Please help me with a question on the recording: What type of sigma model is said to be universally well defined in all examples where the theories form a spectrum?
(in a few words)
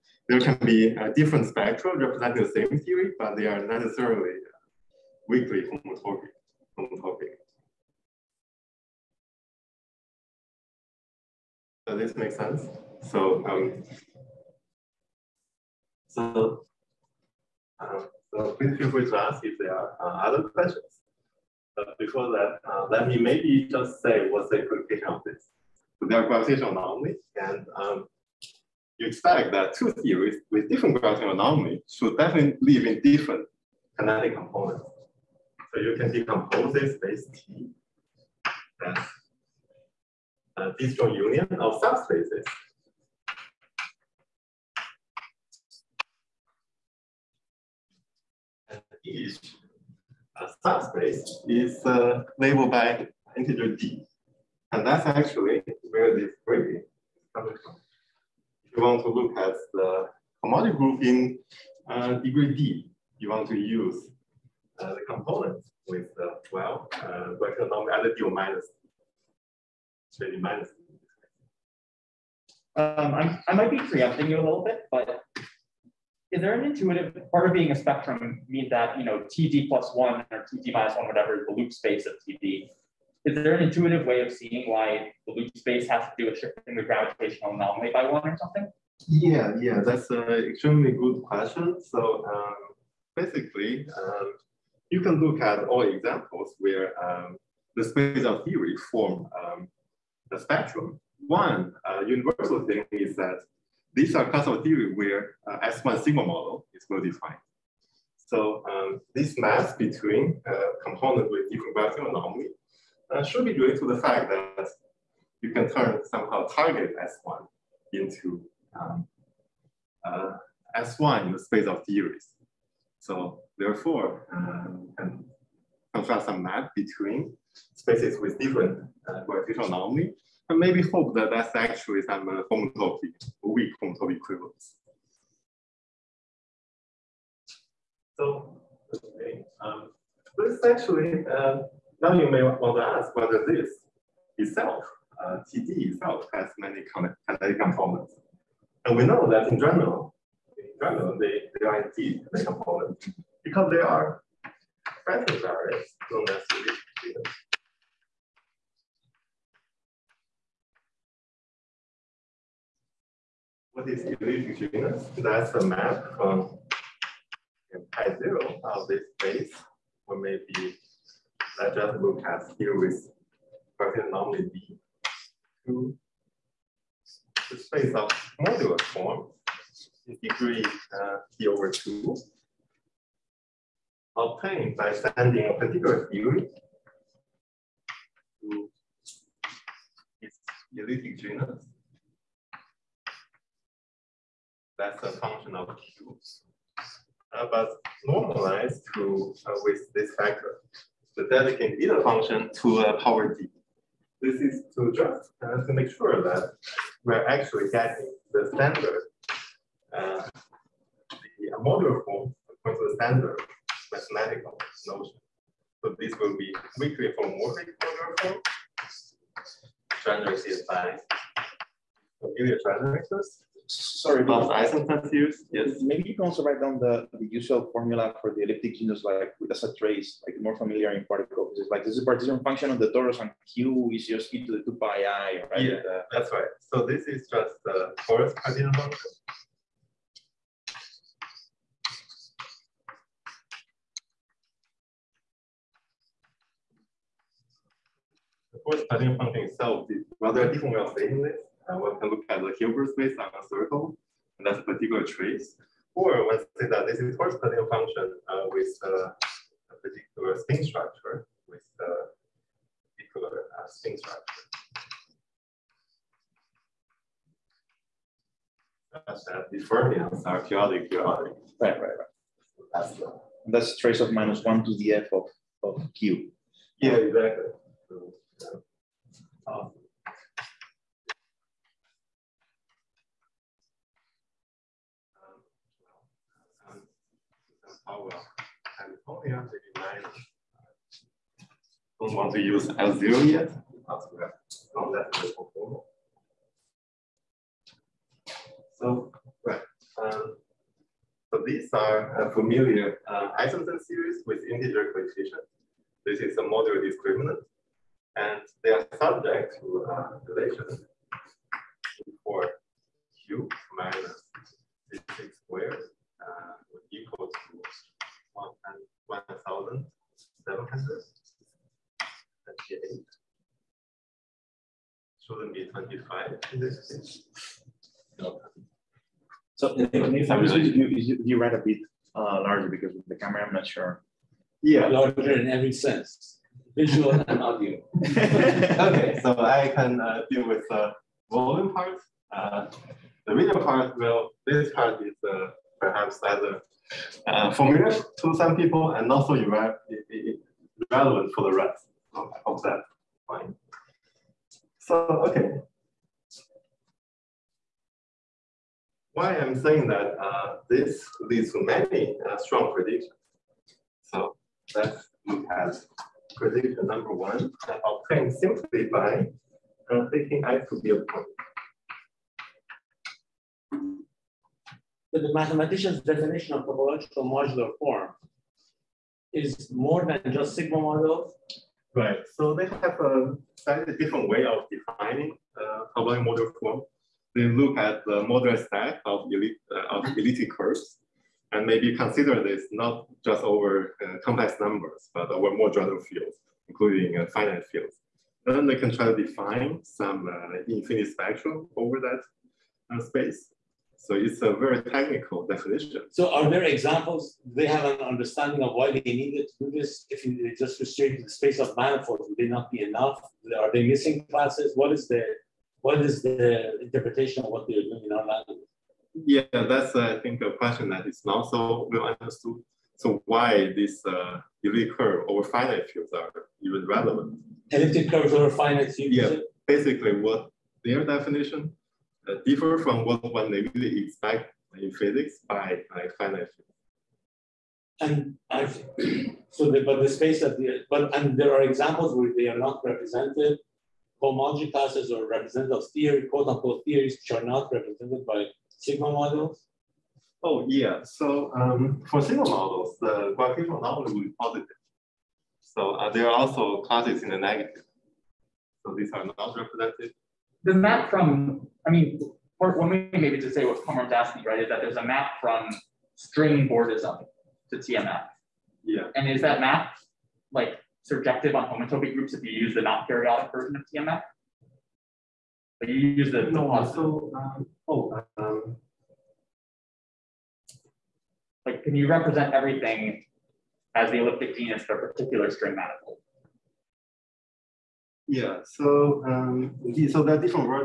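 S1 sigma model.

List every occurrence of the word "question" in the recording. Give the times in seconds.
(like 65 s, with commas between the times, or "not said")
20 s, 91 s, 420 s.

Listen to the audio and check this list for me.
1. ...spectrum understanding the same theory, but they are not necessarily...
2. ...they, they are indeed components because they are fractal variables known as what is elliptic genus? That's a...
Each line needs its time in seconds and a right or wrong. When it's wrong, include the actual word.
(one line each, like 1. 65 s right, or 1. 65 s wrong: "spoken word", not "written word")
1. 1 s wrong: "representing", not "understanding"
2. 151 s right.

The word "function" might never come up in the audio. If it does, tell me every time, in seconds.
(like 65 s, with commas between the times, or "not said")
173 s, 195 s, 201 s, 232 s, 238 s, 249 s, 257 s.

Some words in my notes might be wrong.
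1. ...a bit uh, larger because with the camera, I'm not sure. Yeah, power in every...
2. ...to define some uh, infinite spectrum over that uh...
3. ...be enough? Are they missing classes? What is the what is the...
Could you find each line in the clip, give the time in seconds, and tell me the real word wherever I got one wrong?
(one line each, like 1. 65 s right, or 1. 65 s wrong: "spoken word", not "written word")
1. 331 s wrong: "larger", not "power"
2. 399 s right
3. 412 s right.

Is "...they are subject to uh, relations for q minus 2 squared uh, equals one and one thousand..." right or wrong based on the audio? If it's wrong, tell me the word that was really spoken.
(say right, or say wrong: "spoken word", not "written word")
wrong: "6", not "2".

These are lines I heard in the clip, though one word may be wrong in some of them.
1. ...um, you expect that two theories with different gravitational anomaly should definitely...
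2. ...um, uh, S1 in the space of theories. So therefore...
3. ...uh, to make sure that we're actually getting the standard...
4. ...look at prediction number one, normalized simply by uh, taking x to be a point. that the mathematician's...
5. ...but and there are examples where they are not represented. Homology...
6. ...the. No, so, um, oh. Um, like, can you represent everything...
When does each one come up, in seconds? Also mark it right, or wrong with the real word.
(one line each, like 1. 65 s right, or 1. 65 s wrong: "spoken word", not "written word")
1. 27 s right
2. 118 s right
3. 205 s right
4. 365 s wrong: "obtained", not "normalized"
5. 440 s right
6. 476 s right.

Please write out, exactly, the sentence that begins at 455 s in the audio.
So uh, there are also classes in the negative.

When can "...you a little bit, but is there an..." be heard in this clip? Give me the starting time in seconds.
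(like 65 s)
74 s.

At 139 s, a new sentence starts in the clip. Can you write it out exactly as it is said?
Um, this actually, uh, now you may want to ask whether this itself, uh, TD itself, has many connected components.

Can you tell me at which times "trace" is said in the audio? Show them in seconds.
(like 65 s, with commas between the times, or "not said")
229 s, 255 s, 273 s.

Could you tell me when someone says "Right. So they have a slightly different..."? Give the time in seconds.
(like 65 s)
381 s.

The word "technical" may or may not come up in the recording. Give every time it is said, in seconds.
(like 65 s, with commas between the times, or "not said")
404 s.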